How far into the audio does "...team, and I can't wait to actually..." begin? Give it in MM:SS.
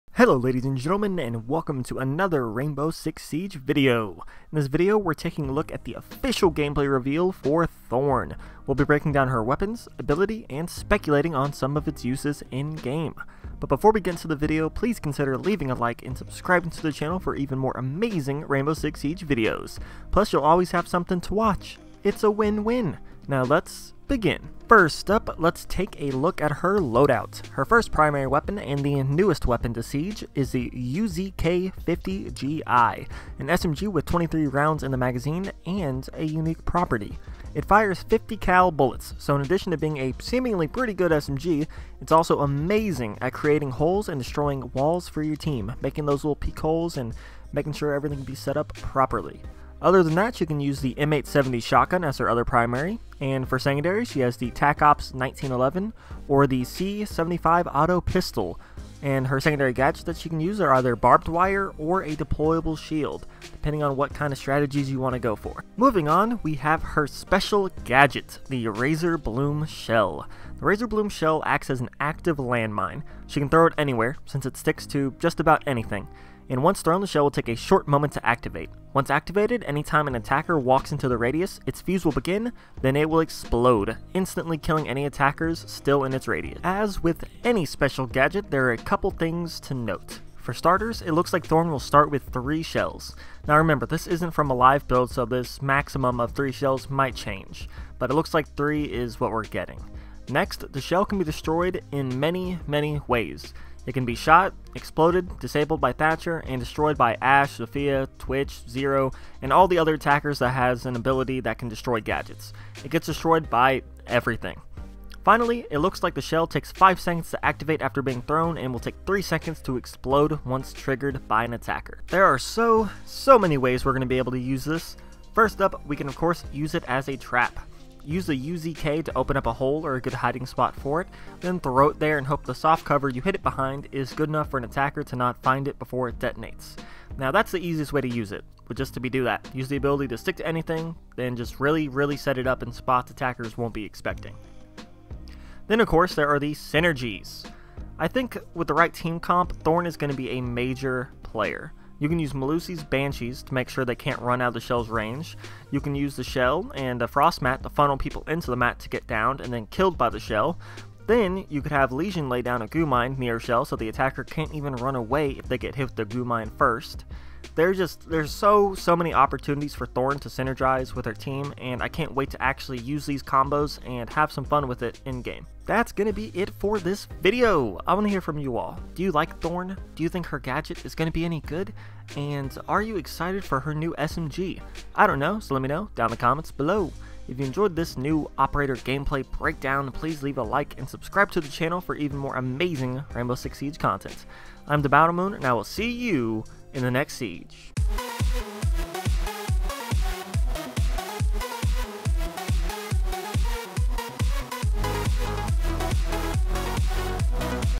02:51.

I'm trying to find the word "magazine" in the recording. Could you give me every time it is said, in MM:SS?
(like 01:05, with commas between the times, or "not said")
00:34.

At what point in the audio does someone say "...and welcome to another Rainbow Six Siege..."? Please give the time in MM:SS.
00:01.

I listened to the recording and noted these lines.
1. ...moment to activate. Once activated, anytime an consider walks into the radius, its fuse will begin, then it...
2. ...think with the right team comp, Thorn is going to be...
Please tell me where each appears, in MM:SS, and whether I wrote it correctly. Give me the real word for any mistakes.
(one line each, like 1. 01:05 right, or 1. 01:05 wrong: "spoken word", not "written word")
1. 01:17 wrong: "attacker", not "consider"
2. 02:28 right.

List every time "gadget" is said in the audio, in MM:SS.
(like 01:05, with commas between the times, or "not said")
00:59, 01:07, 01:28, 01:51, 03:00.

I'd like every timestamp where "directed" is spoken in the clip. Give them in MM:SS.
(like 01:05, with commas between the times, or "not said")
not said.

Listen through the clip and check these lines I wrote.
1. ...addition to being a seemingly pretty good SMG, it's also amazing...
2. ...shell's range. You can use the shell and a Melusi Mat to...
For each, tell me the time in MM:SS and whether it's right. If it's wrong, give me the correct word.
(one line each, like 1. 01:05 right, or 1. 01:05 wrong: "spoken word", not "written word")
1. 00:39 right
2. 02:34 wrong: "Frost", not "Melusi".